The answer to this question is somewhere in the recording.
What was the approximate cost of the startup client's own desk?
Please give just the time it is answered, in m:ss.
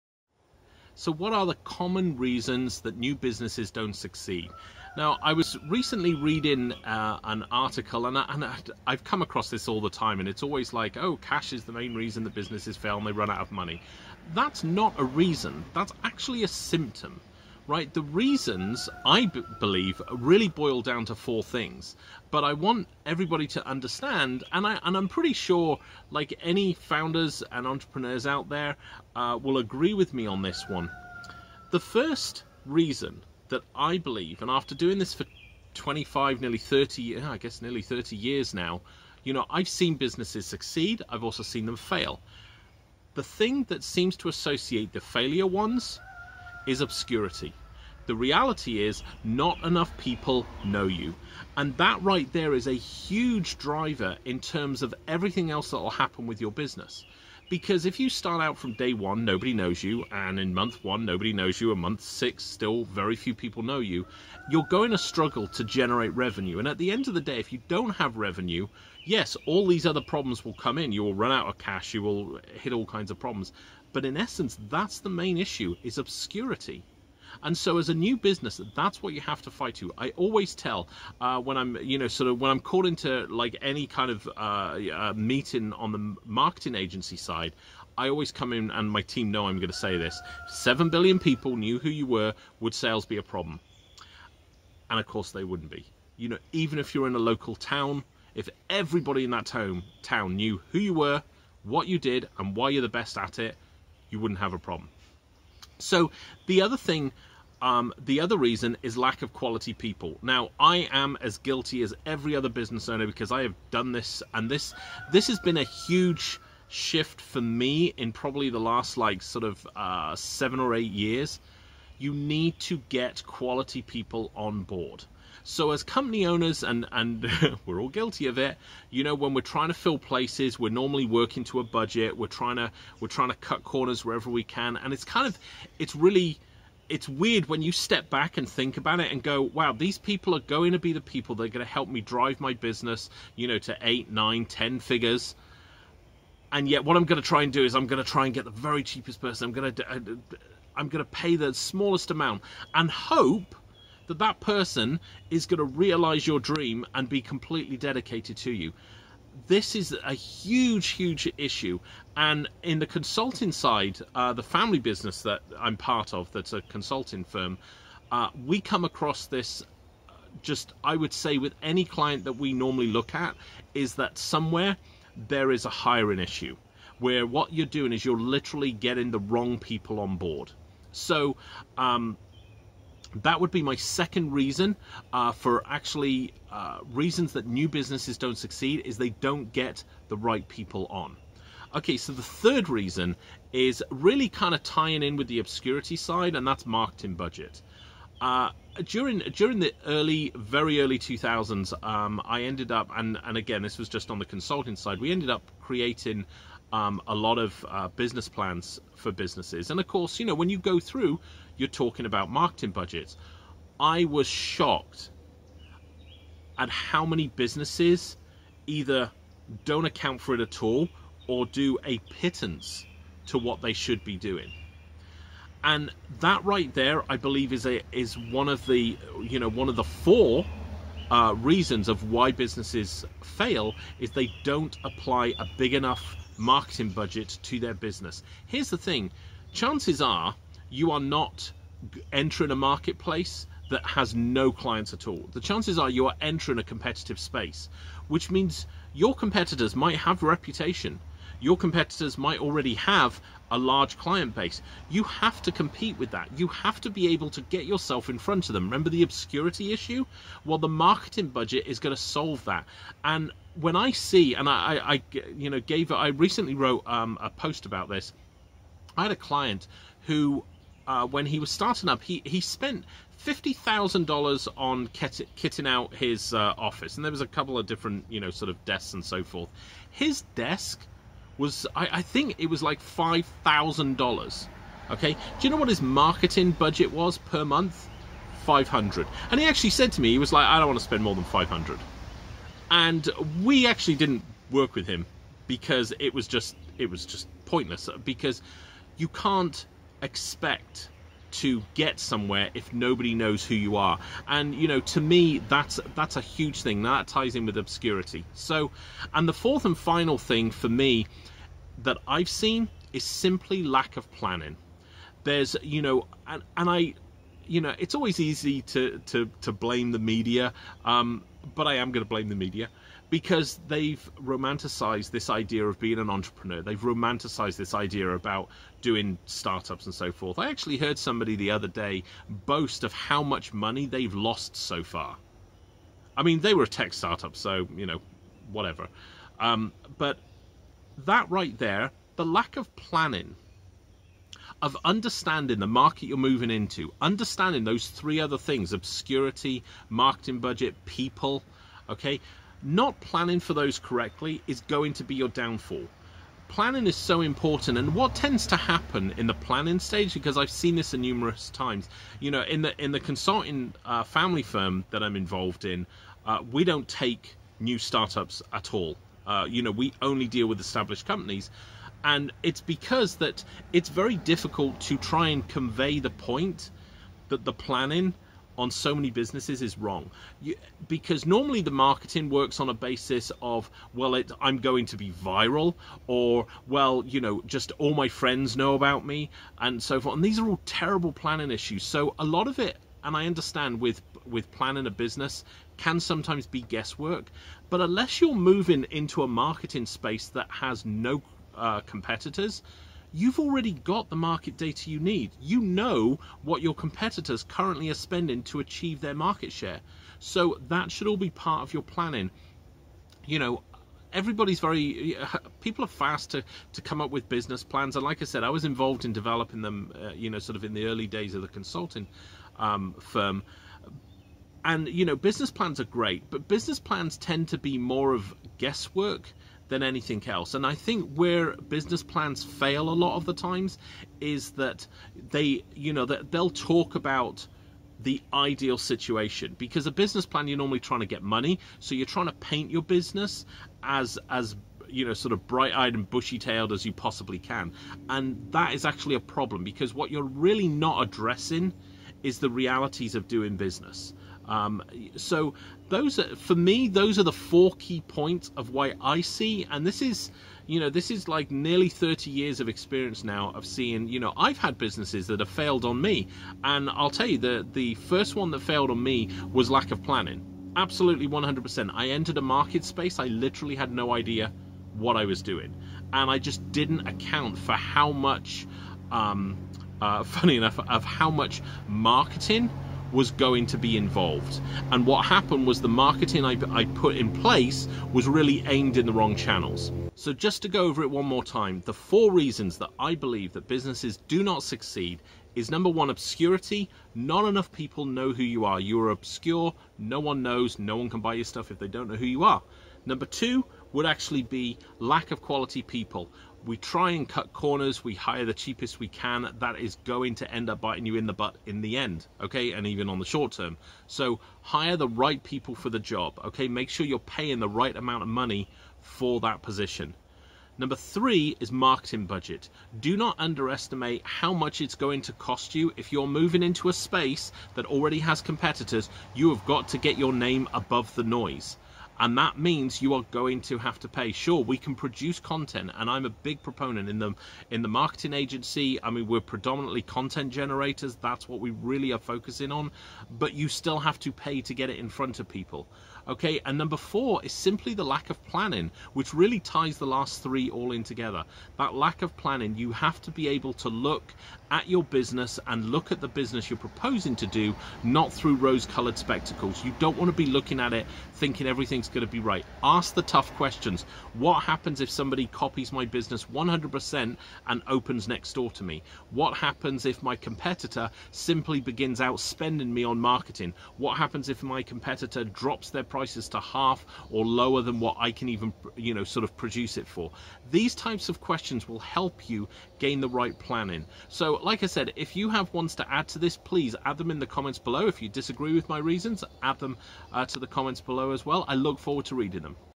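4:42.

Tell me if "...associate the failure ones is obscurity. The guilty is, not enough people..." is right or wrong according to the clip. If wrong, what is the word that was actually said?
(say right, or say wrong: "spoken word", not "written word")
wrong: "reality", not "guilty".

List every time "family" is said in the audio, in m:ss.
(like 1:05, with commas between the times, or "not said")
2:44, 6:04.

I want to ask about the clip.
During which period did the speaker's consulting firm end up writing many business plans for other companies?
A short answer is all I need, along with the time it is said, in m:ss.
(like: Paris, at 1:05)
early 2000s, at 3:20.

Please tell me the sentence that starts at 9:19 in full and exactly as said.
You don't want to be looking at it thinking everything's going to be right.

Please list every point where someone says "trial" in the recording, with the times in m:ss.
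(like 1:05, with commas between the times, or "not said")
not said.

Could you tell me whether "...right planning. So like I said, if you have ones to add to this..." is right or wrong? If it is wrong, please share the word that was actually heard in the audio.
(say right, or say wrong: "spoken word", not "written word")
right.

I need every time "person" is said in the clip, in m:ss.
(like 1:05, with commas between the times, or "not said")
2:29, 2:34.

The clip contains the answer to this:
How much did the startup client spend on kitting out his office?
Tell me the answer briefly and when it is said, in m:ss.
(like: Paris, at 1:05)
$50,000, at 4:33.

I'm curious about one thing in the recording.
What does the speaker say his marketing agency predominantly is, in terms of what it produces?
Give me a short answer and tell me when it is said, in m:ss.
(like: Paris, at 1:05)
Content generators, at 9:00.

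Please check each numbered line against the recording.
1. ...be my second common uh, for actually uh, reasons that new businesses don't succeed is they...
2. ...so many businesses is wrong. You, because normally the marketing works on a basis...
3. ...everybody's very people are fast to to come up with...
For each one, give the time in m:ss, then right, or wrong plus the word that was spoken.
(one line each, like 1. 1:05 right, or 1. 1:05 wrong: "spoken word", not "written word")
1. 3:03 wrong: "reason", not "common"
2. 6:18 right
3. 6:54 right.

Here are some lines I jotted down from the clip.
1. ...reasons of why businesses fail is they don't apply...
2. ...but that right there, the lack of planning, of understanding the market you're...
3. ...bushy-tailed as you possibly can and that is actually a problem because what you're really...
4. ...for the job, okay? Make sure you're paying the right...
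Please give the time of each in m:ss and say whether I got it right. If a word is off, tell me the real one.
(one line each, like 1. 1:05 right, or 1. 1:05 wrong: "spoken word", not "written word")
1. 3:51 right
2. 5:39 right
3. 7:26 right
4. 8:35 right.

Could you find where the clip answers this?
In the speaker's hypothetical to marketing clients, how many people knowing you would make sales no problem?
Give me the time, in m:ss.
1:30.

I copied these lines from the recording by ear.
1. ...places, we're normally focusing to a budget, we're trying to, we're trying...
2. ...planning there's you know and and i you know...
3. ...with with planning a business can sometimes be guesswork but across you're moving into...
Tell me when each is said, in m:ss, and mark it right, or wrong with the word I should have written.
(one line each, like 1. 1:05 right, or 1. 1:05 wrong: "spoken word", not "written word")
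1. 2:09 wrong: "working", not "focusing"
2. 5:14 right
3. 6:33 wrong: "unless", not "across".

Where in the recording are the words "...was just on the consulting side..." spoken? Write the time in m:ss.
3:23.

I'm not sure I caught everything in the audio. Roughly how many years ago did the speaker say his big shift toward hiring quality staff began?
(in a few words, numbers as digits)
seven or eight years.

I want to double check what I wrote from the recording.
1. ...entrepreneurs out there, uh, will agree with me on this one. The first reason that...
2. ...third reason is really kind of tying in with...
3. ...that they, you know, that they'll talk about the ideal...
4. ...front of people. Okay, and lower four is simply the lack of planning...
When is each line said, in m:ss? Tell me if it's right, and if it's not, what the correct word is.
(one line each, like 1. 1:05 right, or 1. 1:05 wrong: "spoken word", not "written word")
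1. 0:27 right
2. 3:12 right
3. 7:14 right
4. 9:05 wrong: "number", not "lower".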